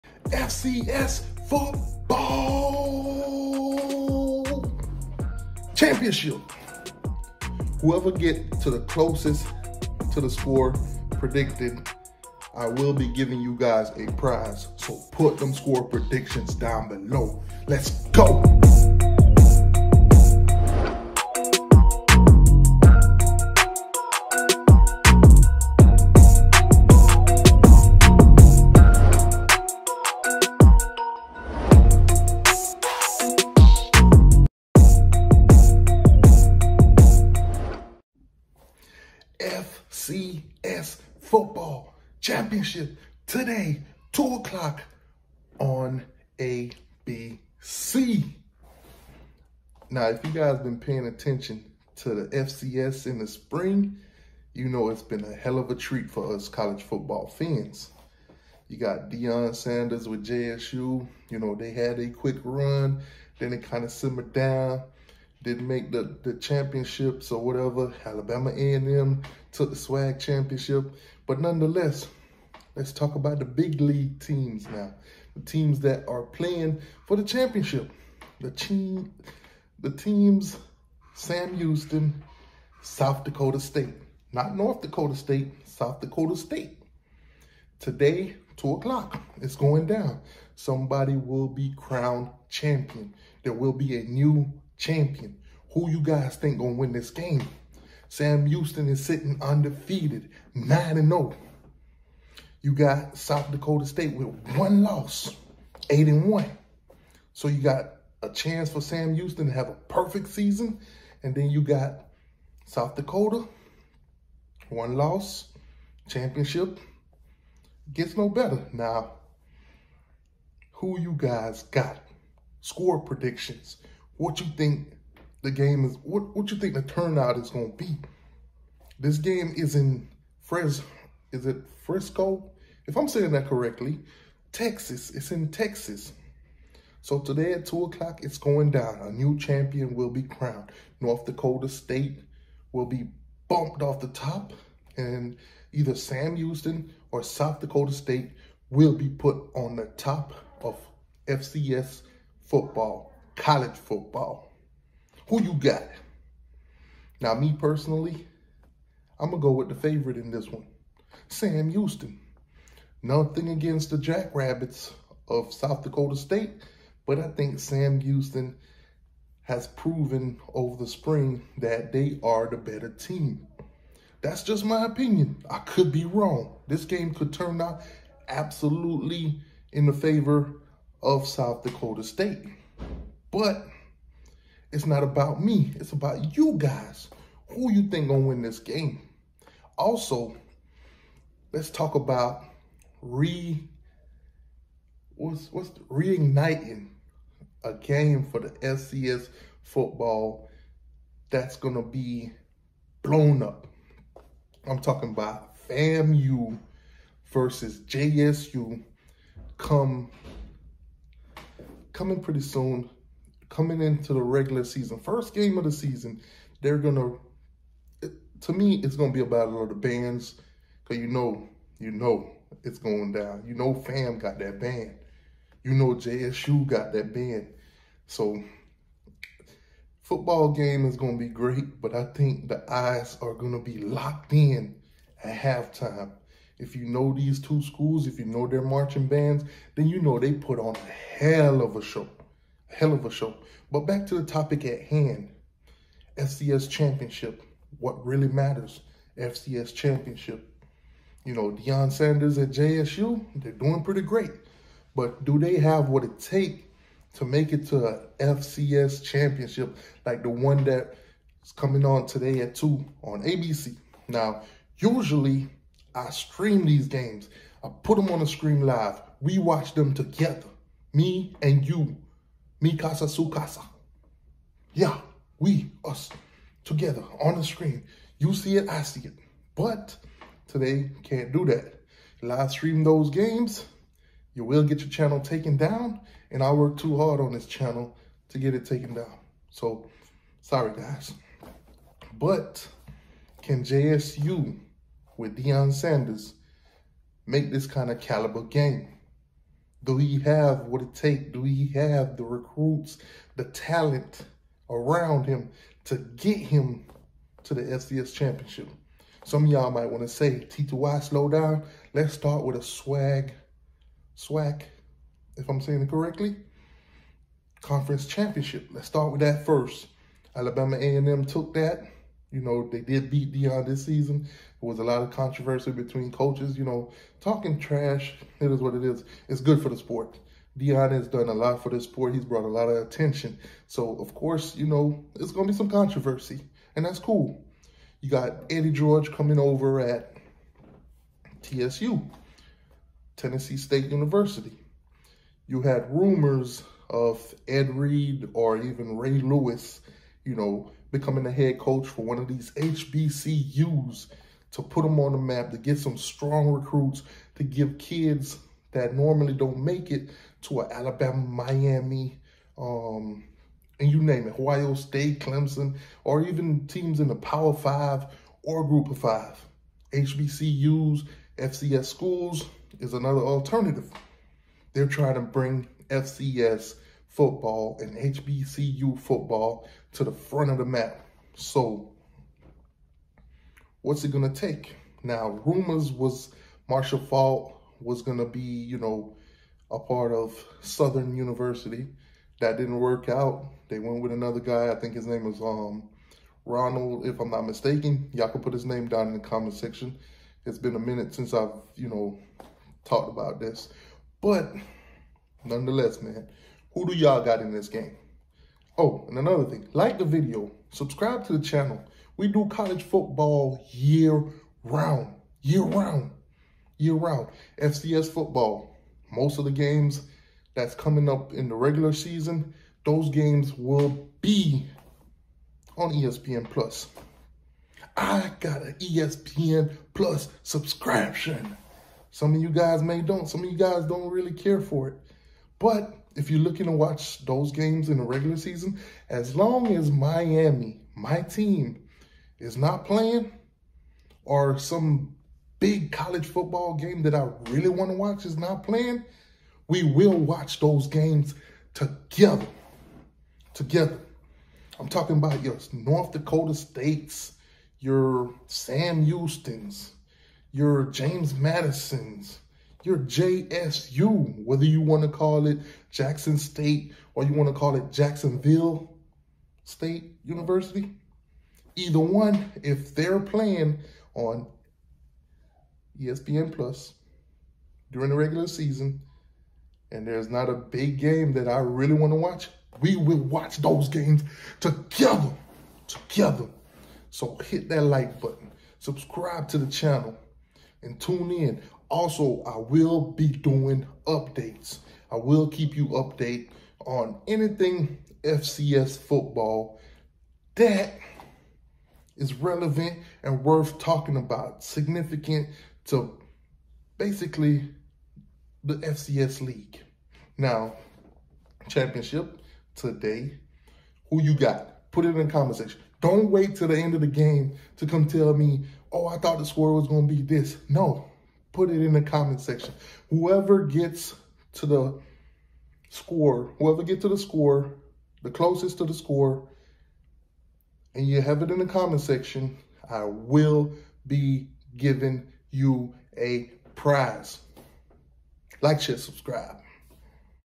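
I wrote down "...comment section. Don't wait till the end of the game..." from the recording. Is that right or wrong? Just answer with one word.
right.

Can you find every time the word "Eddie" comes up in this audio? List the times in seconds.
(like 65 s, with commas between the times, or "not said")
338 s.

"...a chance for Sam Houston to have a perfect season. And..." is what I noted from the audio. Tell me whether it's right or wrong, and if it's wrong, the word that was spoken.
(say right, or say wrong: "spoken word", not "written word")
right.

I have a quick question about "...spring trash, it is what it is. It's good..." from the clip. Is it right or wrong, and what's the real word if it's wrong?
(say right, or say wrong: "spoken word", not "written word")
wrong: "talking", not "spring".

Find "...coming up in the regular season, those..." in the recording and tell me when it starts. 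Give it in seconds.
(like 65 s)
420 s.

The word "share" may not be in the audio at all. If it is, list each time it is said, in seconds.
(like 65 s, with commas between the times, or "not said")
538 s.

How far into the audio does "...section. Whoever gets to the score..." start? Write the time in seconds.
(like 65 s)
522 s.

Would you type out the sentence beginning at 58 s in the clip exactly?
You got Deion Sanders with JSU.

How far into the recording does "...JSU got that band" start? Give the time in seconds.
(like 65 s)
225 s.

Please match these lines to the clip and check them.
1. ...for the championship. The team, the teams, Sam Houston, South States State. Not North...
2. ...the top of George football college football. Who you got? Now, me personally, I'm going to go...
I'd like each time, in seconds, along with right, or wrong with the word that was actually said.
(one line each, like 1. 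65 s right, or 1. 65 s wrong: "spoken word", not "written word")
1. 77 s wrong: "Dakota", not "States"
2. 149 s wrong: "FCS", not "George".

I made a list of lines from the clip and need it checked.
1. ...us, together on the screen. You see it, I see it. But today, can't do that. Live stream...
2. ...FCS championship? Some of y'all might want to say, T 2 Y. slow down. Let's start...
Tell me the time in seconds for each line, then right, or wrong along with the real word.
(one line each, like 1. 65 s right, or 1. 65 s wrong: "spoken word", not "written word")
1. 275 s right
2. 307 s right.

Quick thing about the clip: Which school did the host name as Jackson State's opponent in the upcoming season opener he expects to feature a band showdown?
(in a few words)
FAMU.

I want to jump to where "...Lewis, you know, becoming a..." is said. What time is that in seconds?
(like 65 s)
349 s.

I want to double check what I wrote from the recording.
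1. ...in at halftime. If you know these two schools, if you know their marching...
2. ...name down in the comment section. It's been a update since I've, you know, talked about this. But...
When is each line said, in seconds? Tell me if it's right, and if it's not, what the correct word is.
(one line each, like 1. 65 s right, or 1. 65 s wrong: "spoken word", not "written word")
1. 234 s right
2. 398 s wrong: "minute", not "update".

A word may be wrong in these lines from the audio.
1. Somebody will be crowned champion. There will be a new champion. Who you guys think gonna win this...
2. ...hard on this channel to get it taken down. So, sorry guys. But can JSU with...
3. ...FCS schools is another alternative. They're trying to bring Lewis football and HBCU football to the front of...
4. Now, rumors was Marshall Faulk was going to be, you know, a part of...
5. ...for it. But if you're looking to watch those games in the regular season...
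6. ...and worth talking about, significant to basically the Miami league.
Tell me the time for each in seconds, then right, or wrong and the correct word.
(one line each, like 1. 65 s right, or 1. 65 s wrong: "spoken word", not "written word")
1. 90 s right
2. 286 s right
3. 371 s wrong: "FCS", not "Lewis"
4. 385 s right
5. 434 s right
6. 503 s wrong: "FCS", not "Miami".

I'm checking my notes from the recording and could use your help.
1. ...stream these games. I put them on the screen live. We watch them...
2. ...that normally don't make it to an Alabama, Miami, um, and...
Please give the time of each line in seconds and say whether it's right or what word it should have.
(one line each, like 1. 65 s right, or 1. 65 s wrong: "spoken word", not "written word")
1. 266 s right
2. 358 s right.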